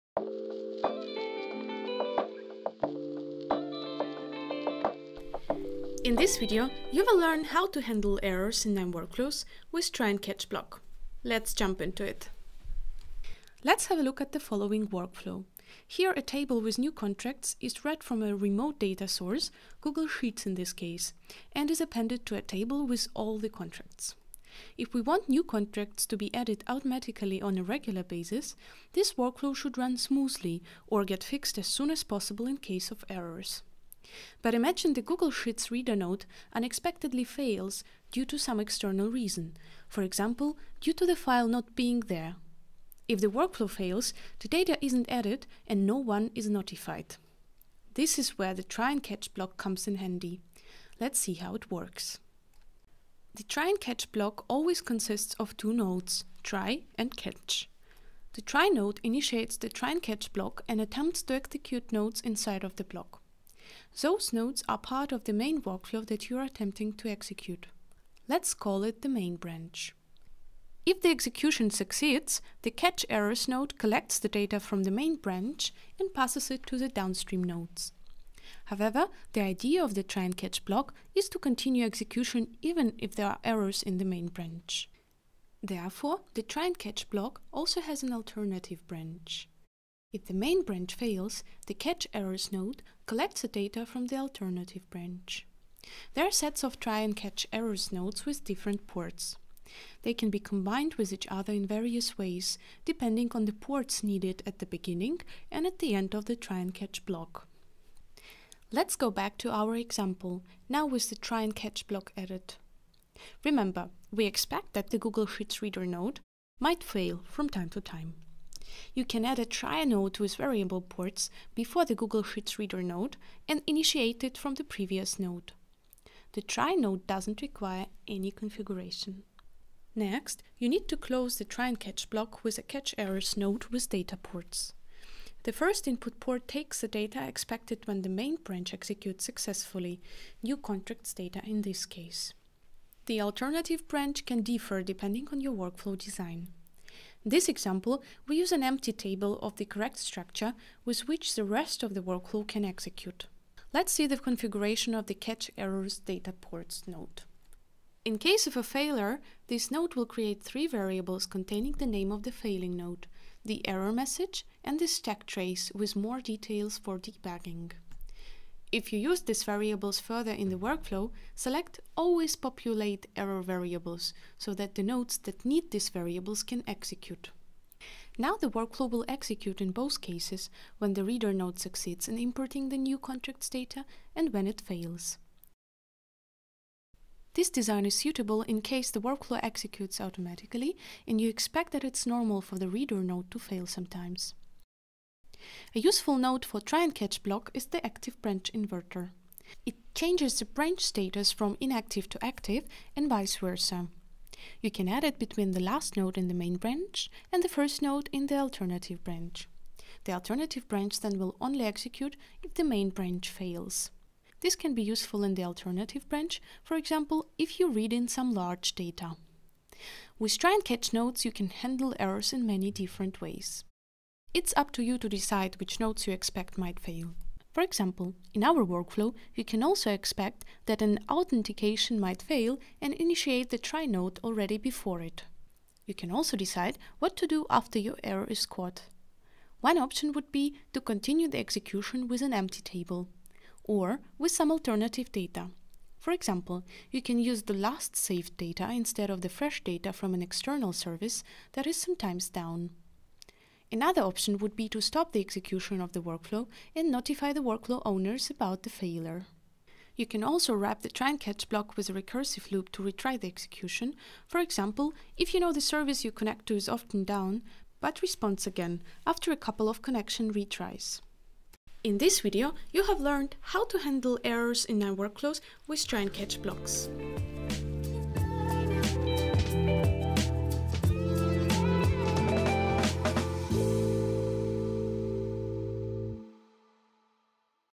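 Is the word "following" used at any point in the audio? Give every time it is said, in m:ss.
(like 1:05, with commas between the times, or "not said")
0:14.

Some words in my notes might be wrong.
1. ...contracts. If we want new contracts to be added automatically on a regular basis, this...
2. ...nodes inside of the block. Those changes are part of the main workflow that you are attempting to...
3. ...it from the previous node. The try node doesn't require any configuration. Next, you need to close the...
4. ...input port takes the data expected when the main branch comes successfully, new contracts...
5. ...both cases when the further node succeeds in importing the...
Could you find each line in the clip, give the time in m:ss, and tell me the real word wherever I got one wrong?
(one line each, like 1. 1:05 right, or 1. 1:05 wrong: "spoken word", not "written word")
1. 0:23 right
2. 1:01 wrong: "nodes", not "changes"
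3. 2:04 right
4. 2:15 wrong: "executes", not "comes"
5. 2:59 wrong: "reader", not "further".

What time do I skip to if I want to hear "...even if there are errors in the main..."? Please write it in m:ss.
1:22.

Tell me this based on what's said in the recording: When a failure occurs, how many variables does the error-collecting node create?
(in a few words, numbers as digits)
3.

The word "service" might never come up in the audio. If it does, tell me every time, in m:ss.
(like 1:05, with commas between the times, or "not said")
4:10, 4:25.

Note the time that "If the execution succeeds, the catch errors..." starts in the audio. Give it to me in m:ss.
1:10.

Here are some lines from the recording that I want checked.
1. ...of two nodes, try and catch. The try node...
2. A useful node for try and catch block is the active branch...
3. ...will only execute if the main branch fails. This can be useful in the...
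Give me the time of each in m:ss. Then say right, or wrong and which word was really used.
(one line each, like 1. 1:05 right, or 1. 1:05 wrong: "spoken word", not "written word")
1. 0:55 right
2. 3:15 right
3. 3:31 right.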